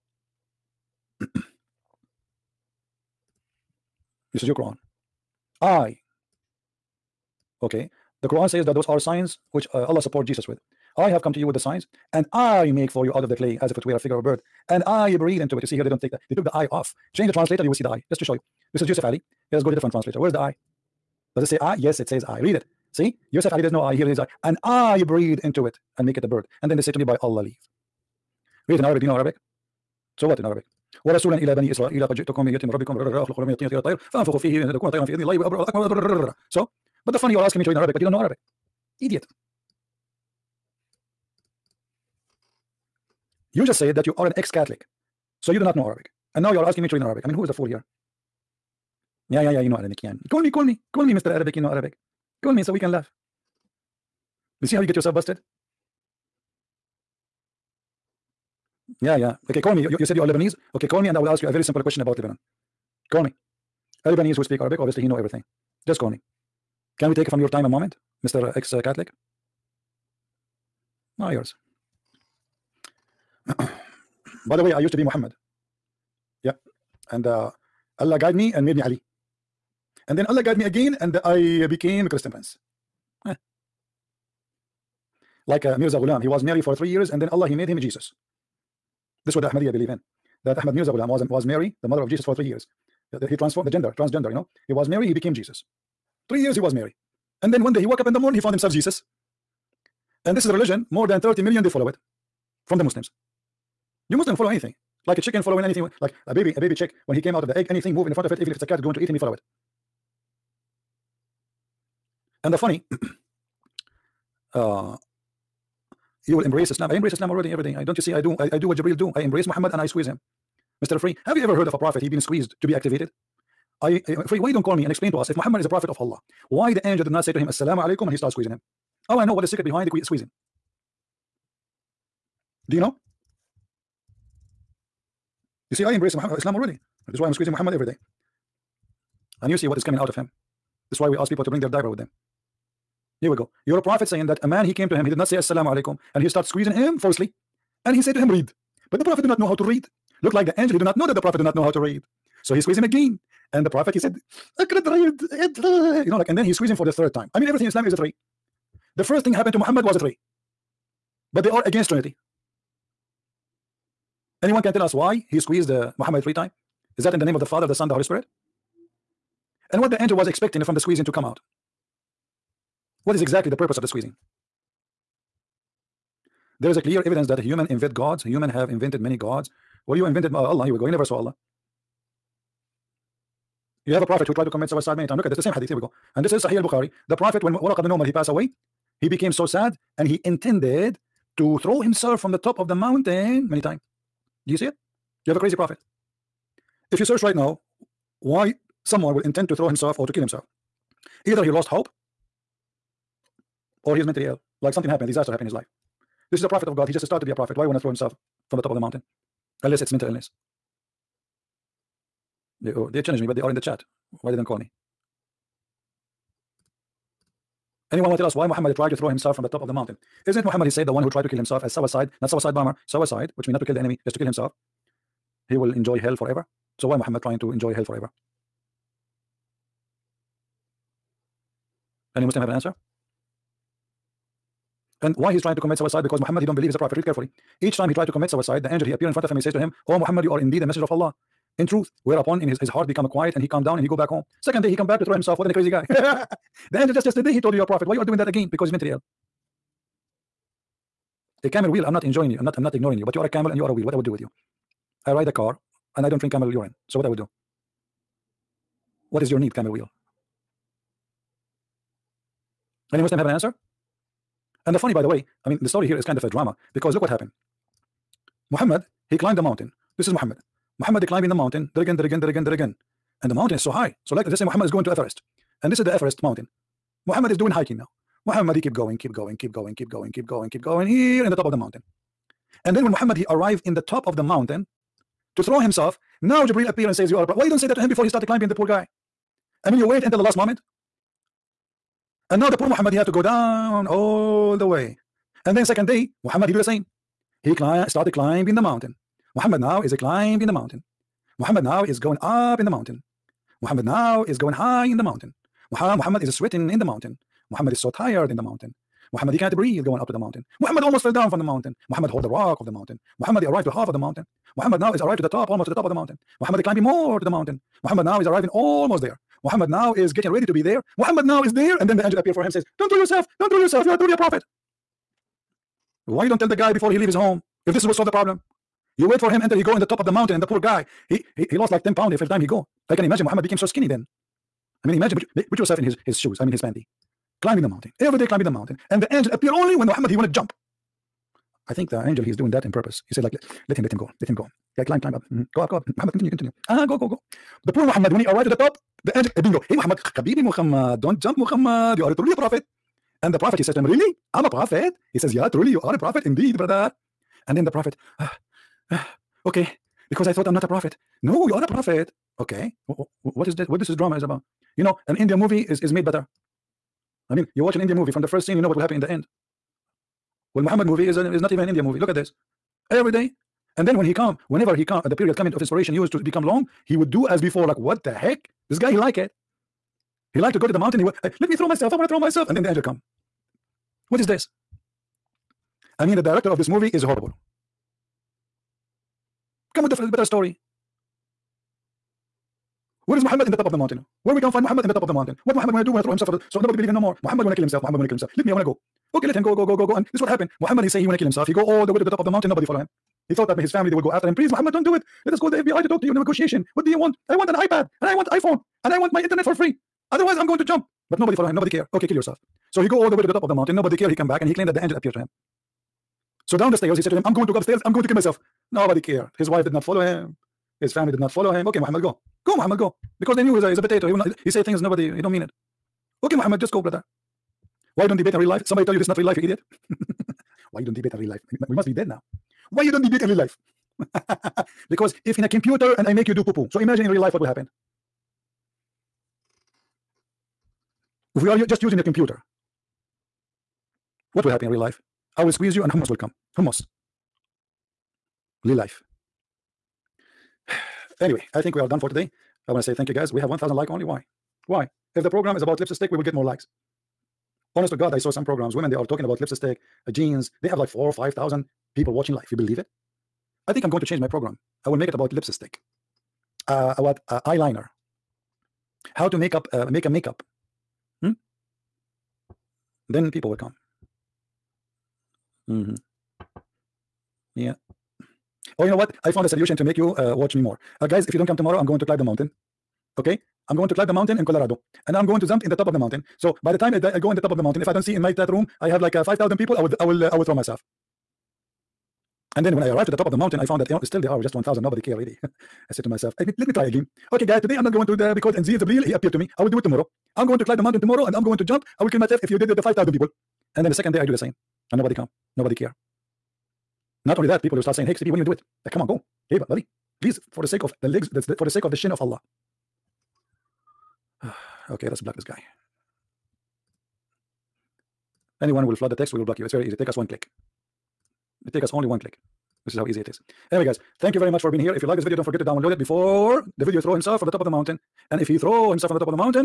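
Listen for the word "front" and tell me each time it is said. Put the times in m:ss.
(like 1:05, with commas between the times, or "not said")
1:48, 3:59.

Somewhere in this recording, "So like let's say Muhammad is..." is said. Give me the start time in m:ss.
4:34.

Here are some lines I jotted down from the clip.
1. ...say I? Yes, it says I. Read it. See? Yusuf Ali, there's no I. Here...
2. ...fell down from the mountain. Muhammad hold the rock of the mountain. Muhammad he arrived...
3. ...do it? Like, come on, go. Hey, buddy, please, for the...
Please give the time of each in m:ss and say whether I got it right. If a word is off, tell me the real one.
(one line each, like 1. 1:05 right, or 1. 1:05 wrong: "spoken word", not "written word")
1. 0:21 right
2. 5:11 right
3. 8:28 right.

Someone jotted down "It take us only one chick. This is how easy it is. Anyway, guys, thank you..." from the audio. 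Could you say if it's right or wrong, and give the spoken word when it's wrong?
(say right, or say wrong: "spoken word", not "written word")
wrong: "click", not "chick".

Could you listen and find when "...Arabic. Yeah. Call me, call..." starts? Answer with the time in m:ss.
0:49.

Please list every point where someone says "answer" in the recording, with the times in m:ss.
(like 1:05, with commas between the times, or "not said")
3:52, 4:23.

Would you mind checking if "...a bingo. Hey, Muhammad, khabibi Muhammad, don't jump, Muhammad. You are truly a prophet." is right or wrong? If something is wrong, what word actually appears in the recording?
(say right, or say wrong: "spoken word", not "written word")
right.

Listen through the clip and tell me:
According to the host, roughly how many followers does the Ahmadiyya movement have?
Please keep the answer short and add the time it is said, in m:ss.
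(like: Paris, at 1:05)
30 million, at 1:41.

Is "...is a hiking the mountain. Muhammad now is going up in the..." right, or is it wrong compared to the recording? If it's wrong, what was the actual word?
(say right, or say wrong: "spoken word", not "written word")
wrong: "climbing", not "hiking".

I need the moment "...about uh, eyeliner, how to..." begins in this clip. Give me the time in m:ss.
7:46.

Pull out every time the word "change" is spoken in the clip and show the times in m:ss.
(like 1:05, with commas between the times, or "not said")
0:17, 7:44.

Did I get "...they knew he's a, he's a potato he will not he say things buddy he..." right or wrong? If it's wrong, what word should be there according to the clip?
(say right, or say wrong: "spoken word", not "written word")
wrong: "nobody", not "buddy".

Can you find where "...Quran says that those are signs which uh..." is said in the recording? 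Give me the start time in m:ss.
0:08.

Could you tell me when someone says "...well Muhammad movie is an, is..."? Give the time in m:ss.
6:10.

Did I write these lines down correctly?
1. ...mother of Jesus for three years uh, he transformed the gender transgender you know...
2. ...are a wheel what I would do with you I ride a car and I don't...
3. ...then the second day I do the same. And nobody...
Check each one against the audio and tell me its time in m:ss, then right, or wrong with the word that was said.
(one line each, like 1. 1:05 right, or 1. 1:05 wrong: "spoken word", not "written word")
1. 1:31 right
2. 4:13 right
3. 8:23 right.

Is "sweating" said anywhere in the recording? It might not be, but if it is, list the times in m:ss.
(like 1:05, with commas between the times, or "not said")
5:06.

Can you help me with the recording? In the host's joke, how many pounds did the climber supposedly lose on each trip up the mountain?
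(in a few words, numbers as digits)
10.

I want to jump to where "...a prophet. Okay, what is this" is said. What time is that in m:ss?
6:01.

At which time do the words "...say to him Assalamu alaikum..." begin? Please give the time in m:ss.
2:07.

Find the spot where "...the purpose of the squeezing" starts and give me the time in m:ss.
2:53.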